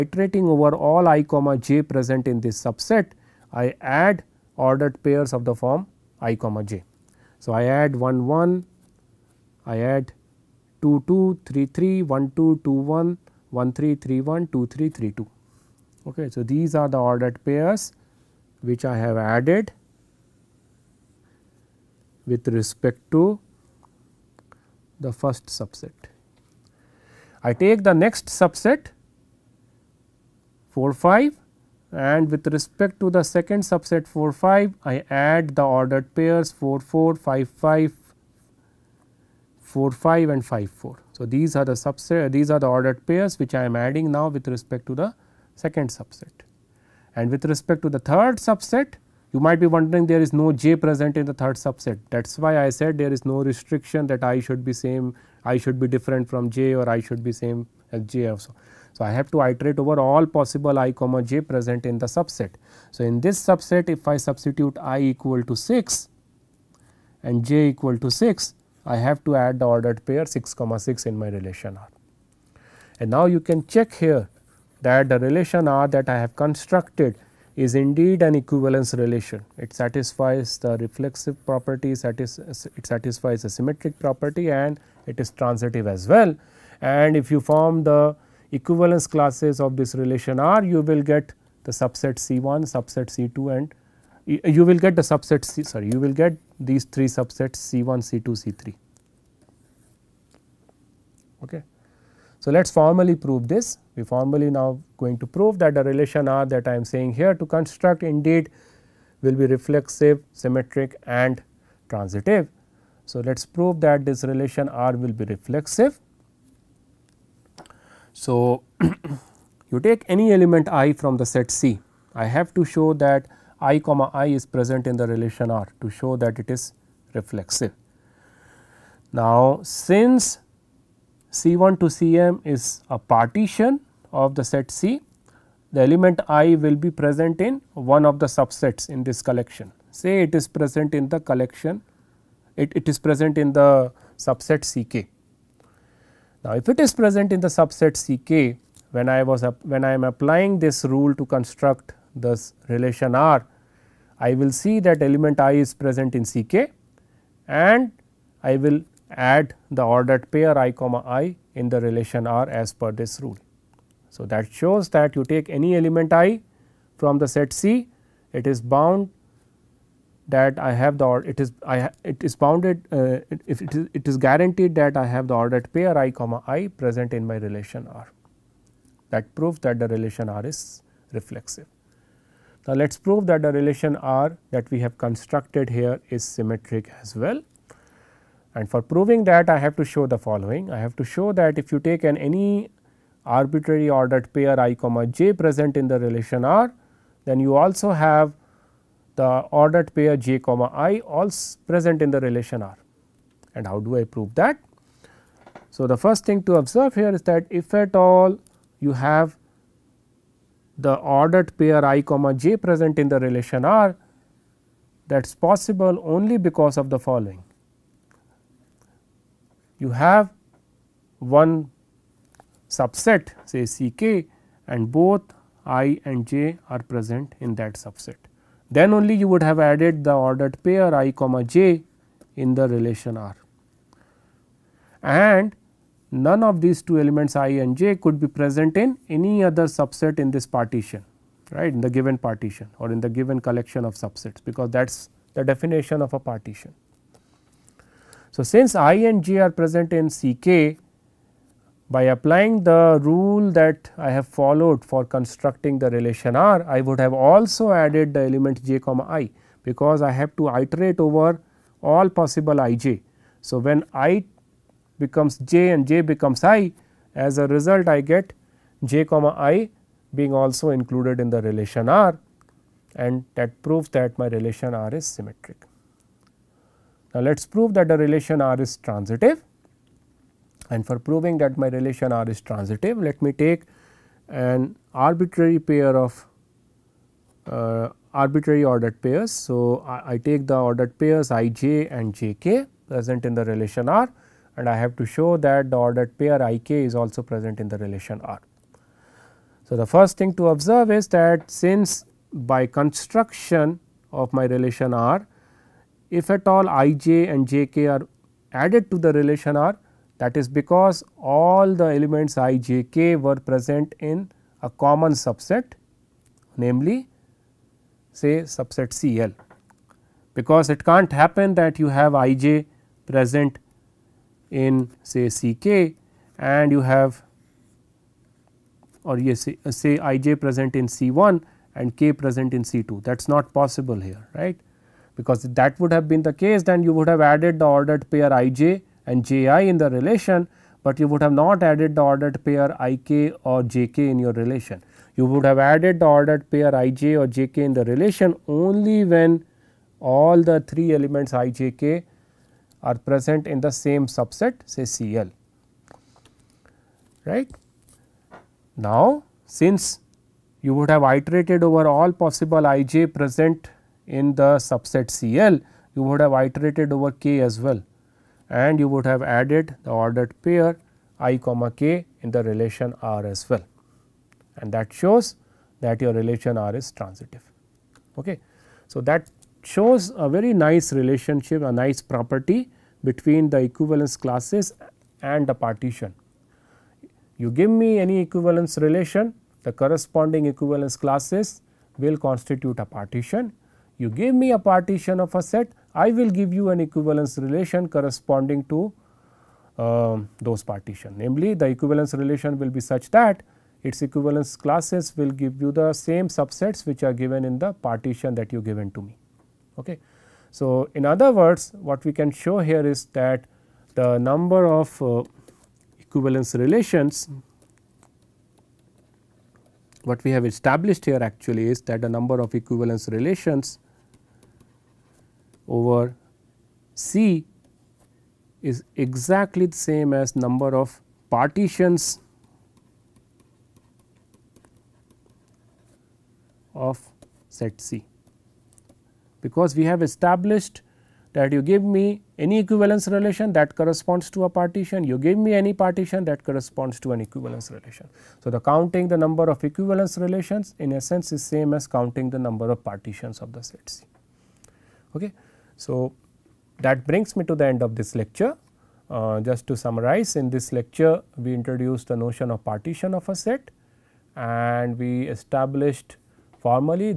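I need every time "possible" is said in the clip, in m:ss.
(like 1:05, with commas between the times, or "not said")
1:00, 3:35, 4:22, 5:33, 6:02.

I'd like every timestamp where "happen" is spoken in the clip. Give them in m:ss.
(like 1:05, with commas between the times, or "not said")
5:21.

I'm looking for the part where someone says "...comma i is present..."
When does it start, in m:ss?
2:03.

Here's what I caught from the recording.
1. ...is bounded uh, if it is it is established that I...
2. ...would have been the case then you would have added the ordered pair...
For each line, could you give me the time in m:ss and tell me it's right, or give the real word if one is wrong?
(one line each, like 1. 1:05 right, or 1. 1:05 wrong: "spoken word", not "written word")
1. 2:52 wrong: "guaranteed", not "established"
2. 5:35 right.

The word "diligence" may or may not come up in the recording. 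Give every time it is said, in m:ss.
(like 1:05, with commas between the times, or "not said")
not said.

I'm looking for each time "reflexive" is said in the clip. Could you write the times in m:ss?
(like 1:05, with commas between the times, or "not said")
1:20, 1:49, 1:55, 2:07, 3:01.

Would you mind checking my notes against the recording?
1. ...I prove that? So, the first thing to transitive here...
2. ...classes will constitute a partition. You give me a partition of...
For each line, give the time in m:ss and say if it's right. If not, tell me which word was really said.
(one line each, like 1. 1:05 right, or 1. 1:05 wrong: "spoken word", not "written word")
1. 3:23 wrong: "observe", not "transitive"
2. 6:30 right.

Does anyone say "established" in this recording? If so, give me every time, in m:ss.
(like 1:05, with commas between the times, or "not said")
7:00, 7:20, 7:45.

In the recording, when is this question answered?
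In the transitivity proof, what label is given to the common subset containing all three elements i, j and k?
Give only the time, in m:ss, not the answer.
5:18.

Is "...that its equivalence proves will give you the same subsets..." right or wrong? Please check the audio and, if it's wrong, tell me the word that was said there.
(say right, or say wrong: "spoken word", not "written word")
wrong: "classes", not "proves".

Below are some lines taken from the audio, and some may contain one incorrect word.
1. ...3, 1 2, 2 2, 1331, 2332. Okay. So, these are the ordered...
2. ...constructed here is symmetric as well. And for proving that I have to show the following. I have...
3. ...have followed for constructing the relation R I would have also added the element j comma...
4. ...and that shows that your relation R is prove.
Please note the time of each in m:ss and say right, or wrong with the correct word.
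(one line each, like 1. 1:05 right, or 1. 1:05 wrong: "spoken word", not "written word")
1. 0:11 wrong: "1", not "2"
2. 3:04 right
3. 4:14 right
4. 6:14 wrong: "transitive", not "prove".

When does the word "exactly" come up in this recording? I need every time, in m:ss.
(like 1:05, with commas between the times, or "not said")
7:08.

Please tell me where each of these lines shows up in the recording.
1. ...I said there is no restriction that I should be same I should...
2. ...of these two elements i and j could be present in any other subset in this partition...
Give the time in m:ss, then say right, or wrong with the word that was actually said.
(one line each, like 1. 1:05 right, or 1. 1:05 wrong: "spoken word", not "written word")
1. 0:52 right
2. 3:56 right.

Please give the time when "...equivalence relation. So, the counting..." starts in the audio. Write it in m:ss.
7:27.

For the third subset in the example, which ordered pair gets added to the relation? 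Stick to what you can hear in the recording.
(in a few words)
6, 6.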